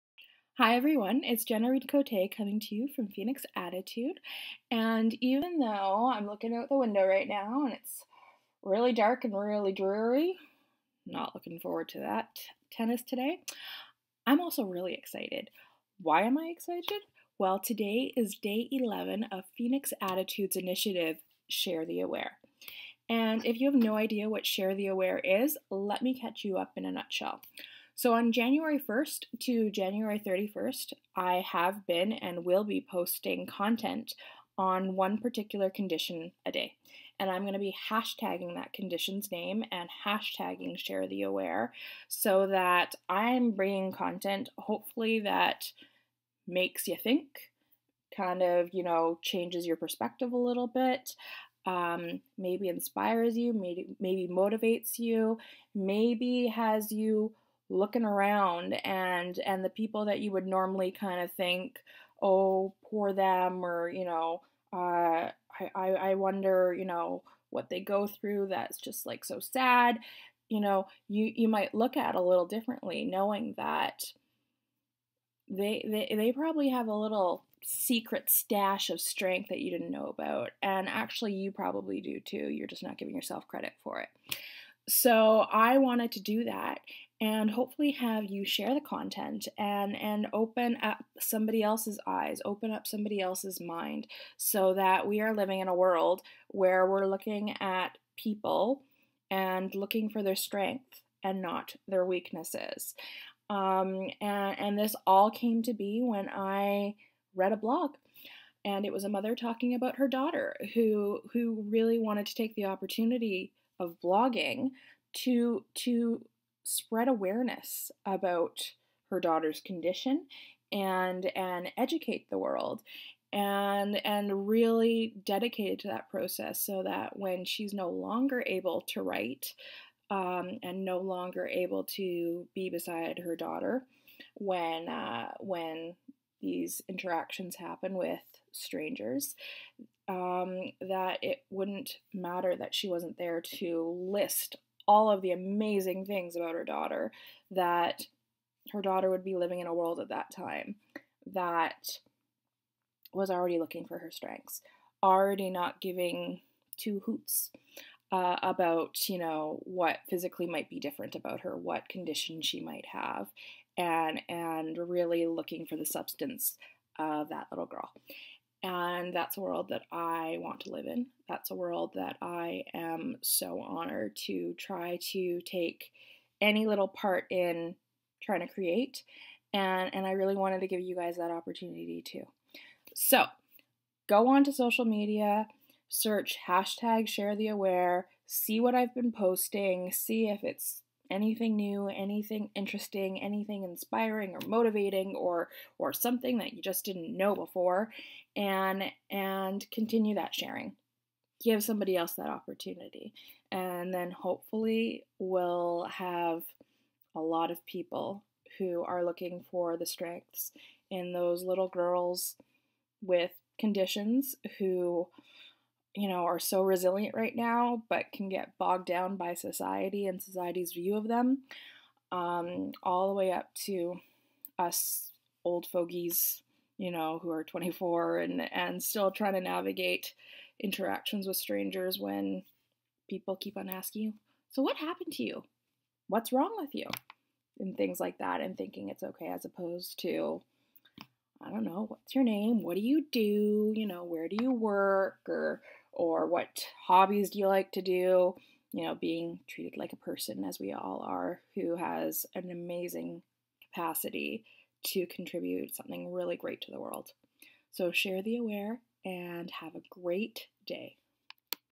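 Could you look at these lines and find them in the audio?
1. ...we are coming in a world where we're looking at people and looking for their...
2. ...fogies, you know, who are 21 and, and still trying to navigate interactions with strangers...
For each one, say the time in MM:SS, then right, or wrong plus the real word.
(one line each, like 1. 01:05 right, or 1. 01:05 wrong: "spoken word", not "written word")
1. 01:35 wrong: "living", not "coming"
2. 03:45 wrong: "24", not "21".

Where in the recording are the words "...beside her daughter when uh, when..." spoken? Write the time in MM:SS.
02:12.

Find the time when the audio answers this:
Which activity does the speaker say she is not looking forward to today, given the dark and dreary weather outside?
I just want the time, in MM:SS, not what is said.
00:12.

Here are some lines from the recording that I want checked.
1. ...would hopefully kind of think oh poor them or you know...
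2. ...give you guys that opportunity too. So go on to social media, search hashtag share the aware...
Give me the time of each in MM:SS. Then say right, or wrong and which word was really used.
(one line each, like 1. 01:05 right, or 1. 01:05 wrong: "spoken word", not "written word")
1. 01:00 wrong: "normally", not "hopefully"
2. 03:00 right.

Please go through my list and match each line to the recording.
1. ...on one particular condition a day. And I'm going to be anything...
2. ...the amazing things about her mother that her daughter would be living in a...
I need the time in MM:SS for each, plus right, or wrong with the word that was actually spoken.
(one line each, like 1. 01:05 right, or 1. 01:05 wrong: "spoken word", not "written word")
1. 00:34 wrong: "hashtagging", not "anything"
2. 02:25 wrong: "daughter", not "mother".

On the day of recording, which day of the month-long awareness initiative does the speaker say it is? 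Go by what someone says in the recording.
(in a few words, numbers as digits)
11.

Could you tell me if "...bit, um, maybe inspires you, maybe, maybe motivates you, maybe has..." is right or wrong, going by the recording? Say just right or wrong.
right.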